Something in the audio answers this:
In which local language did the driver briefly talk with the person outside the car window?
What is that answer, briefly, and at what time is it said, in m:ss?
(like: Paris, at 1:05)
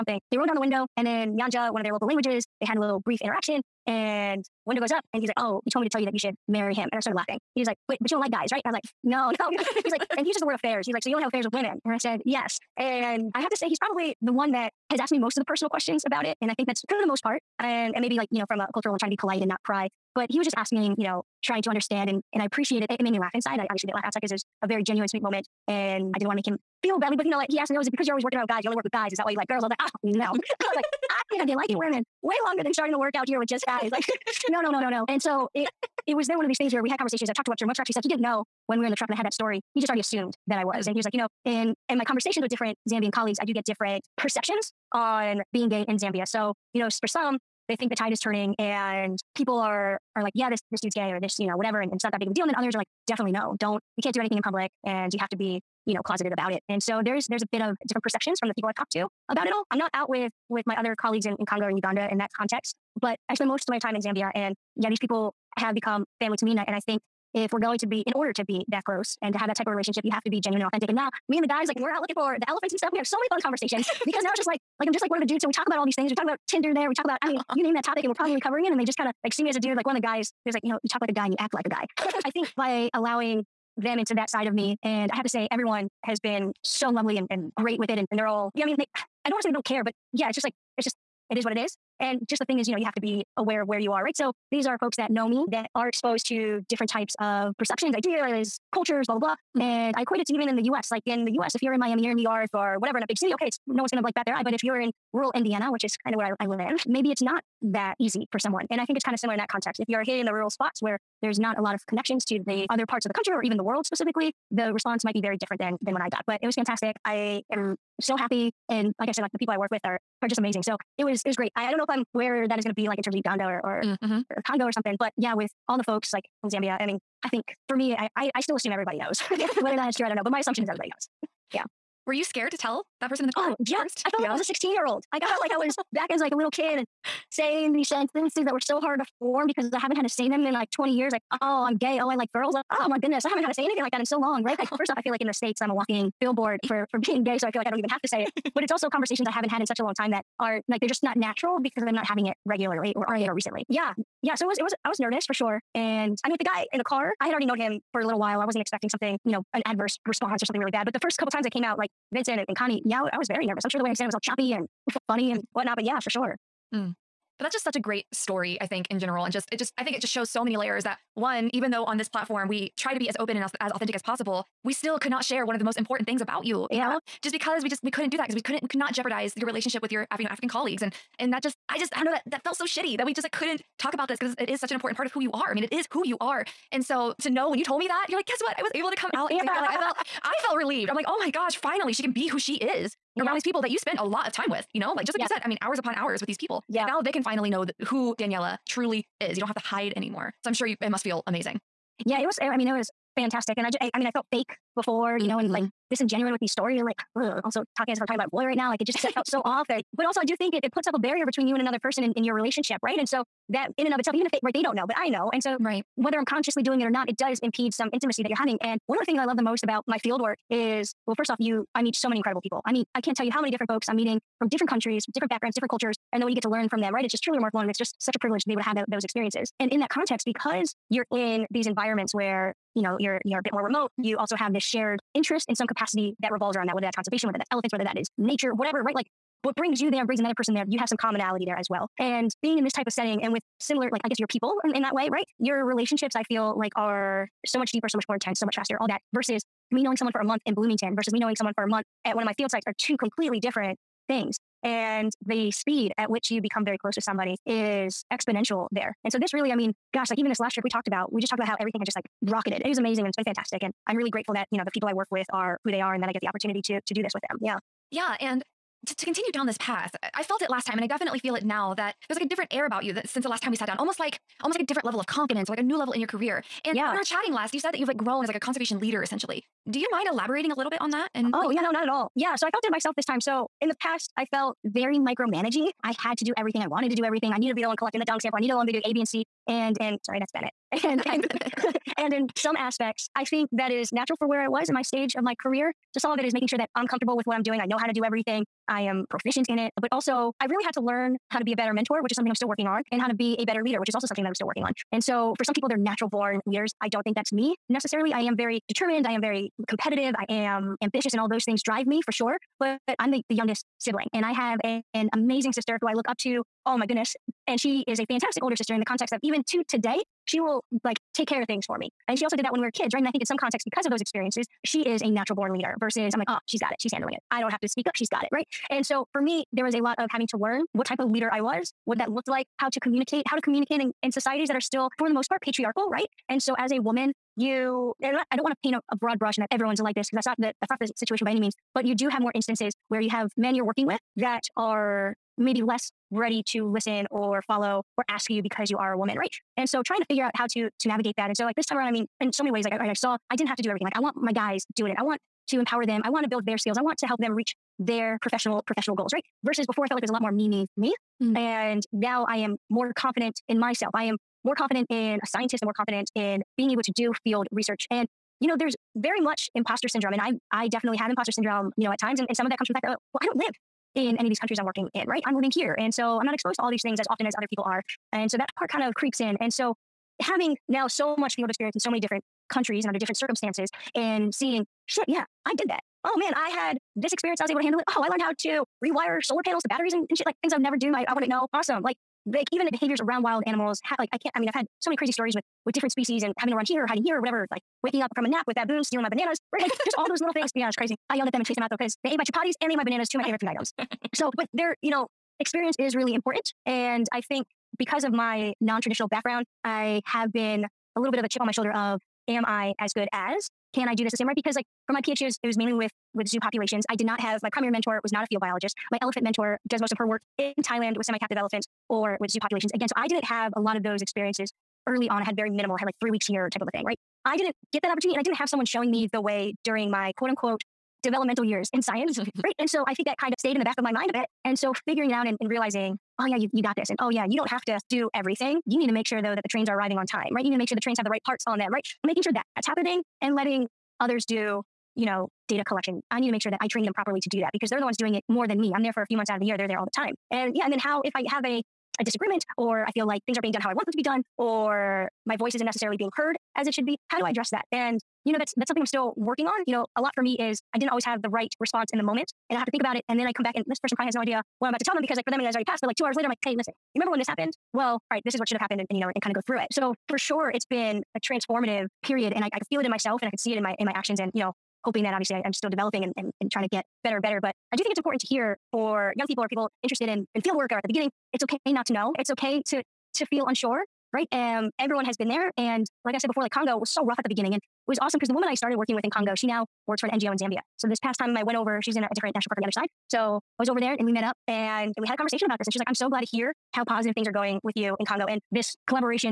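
Nyanja, at 0:01.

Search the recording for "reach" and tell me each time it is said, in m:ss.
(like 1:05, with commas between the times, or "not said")
5:57.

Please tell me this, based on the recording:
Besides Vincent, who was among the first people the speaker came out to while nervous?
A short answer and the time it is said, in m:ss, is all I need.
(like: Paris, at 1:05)
Connie, at 2:42.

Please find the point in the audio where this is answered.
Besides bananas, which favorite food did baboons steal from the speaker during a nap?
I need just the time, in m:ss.
6:42.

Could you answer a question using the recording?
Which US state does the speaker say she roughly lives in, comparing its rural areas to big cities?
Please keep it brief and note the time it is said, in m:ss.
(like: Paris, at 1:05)
Indiana, at 1:45.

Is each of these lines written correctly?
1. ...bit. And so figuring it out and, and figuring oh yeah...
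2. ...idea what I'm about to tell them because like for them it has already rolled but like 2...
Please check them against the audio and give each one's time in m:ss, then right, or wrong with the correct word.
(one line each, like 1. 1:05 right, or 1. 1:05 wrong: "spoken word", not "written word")
1. 7:14 wrong: "realizing", not "figuring"
2. 7:44 wrong: "passed", not "rolled".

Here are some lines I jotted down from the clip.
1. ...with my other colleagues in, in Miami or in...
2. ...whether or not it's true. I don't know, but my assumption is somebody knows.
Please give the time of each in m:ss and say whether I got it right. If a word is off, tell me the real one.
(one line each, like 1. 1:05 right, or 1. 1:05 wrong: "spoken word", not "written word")
1. 1:00 wrong: "Congo", not "Miami"
2. 2:09 wrong: "everybody", not "somebody".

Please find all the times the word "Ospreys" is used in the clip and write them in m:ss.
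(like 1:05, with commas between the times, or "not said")
not said.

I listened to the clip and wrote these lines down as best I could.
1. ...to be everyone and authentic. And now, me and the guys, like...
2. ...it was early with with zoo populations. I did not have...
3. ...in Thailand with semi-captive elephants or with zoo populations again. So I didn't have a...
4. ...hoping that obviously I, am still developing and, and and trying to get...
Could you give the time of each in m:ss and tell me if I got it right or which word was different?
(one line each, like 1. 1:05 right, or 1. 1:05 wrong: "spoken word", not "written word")
1. 1:10 wrong: "genuine", not "everyone"
2. 6:55 wrong: "mainly", not "early"
3. 7:00 right
4. 7:54 right.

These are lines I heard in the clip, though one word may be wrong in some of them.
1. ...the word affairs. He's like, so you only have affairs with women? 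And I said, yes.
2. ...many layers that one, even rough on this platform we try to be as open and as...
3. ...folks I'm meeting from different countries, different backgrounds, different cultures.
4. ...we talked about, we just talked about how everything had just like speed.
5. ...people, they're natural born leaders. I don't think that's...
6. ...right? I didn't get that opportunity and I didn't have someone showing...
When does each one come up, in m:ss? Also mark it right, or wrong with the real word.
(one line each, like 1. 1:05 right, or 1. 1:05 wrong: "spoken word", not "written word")
1. 0:10 right
2. 2:50 wrong: "though", not "rough"
3. 3:43 right
4. 4:20 wrong: "rocketed", not "speed"
5. 5:05 right
6. 7:06 right.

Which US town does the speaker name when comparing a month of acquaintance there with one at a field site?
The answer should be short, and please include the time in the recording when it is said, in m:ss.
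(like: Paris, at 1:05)
Bloomington, at 4:10.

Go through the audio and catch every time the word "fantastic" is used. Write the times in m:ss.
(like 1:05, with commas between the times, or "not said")
1:56, 3:23, 4:23, 5:18.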